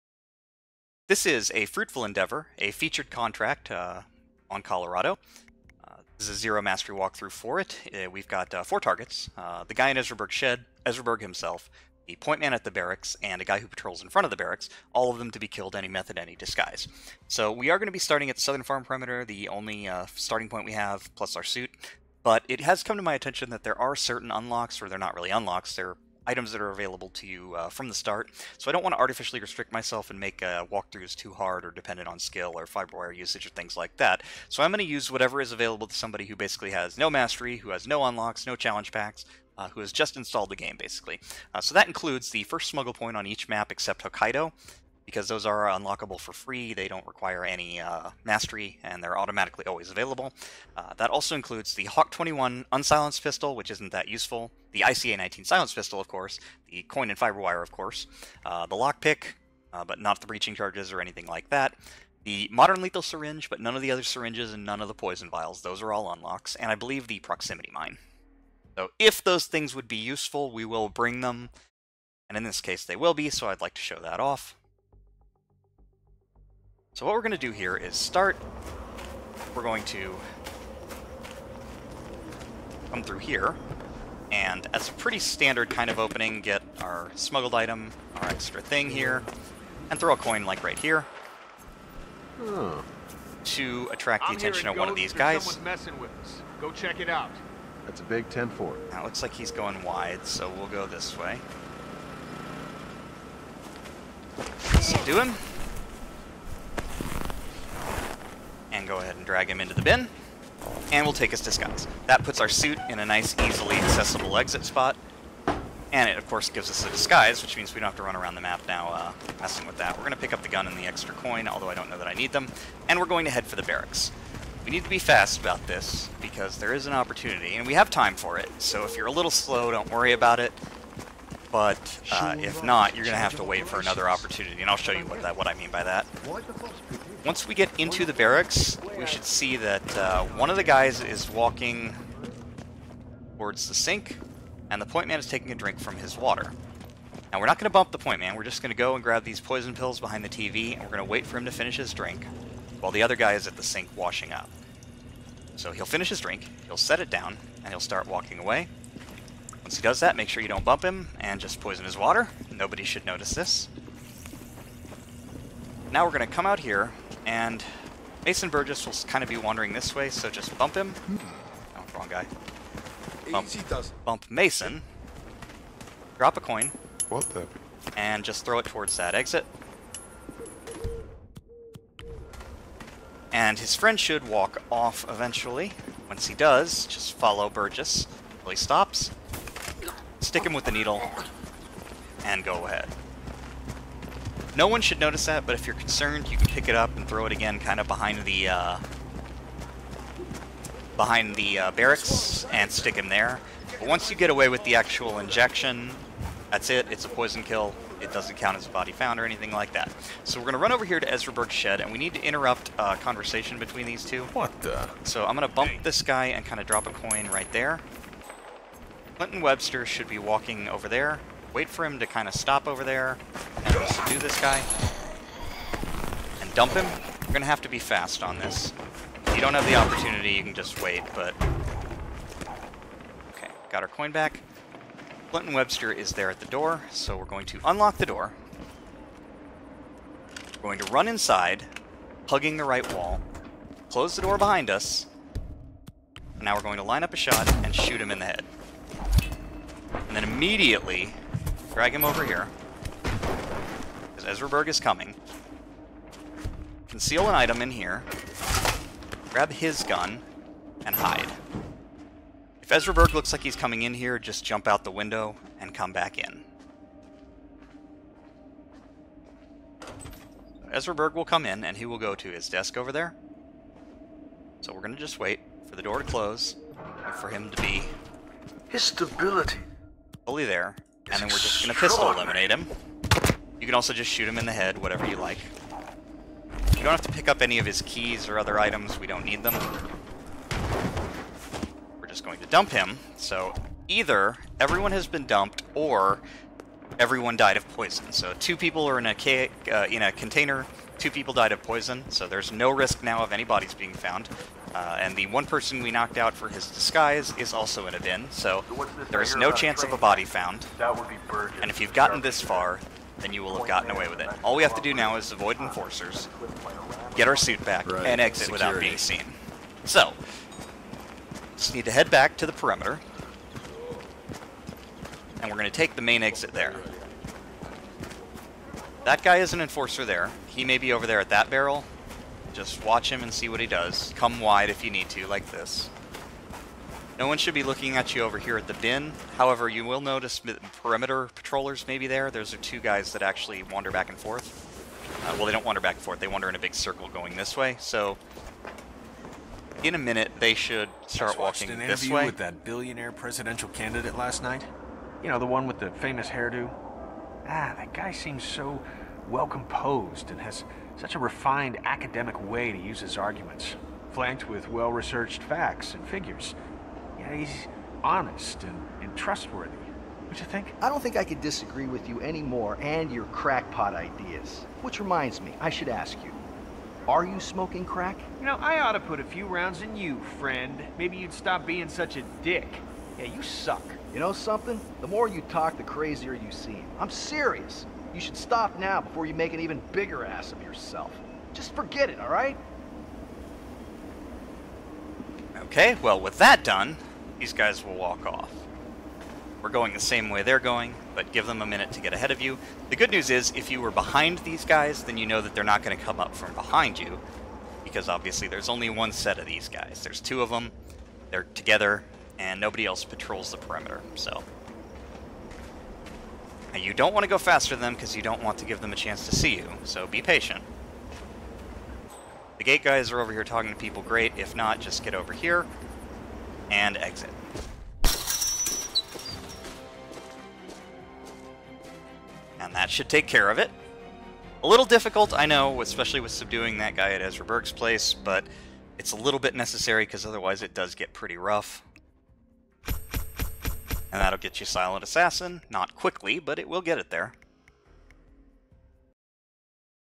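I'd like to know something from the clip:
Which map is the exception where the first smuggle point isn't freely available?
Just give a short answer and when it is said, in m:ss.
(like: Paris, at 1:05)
Hokkaido, at 0:44.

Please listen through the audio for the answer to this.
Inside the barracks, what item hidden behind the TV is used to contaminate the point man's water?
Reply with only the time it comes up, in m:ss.
2:29.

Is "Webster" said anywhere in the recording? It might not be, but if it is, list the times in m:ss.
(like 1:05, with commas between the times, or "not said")
3:39, 3:55.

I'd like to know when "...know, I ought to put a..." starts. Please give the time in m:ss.
6:18.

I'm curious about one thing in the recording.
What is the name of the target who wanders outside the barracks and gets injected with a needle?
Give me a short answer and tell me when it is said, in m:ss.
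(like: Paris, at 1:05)
Mason Burgess, at 2:48.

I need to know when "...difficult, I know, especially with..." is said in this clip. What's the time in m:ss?
7:14.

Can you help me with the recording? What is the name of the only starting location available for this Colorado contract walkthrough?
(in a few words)
Southern farm perimeter.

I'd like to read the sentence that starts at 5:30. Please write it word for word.
He may be over there at that barrel, just watch him and see what he does.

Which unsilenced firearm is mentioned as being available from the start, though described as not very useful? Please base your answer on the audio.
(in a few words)
Hawk 21.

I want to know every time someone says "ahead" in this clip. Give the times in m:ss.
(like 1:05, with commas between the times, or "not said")
1:48, 3:12, 6:42.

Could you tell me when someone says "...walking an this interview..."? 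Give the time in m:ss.
5:51.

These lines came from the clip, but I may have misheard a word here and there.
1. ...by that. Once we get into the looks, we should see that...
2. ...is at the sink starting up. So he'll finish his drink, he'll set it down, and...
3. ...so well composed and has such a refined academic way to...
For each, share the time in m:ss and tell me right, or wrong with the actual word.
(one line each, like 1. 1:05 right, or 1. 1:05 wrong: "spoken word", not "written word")
1. 2:15 wrong: "barracks", not "looks"
2. 2:33 wrong: "washing", not "starting"
3. 5:58 right.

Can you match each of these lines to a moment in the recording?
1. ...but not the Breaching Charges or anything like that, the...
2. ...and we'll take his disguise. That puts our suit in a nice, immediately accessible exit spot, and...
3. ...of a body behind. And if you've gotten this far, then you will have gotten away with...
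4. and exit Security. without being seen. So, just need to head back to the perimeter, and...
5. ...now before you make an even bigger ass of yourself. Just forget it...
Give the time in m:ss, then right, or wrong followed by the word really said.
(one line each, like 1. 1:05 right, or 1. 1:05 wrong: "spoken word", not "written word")
1. 0:59 right
2. 1:50 wrong: "easily", not "immediately"
3. 5:09 wrong: "found", not "behind"
4. 5:18 right
5. 6:28 right.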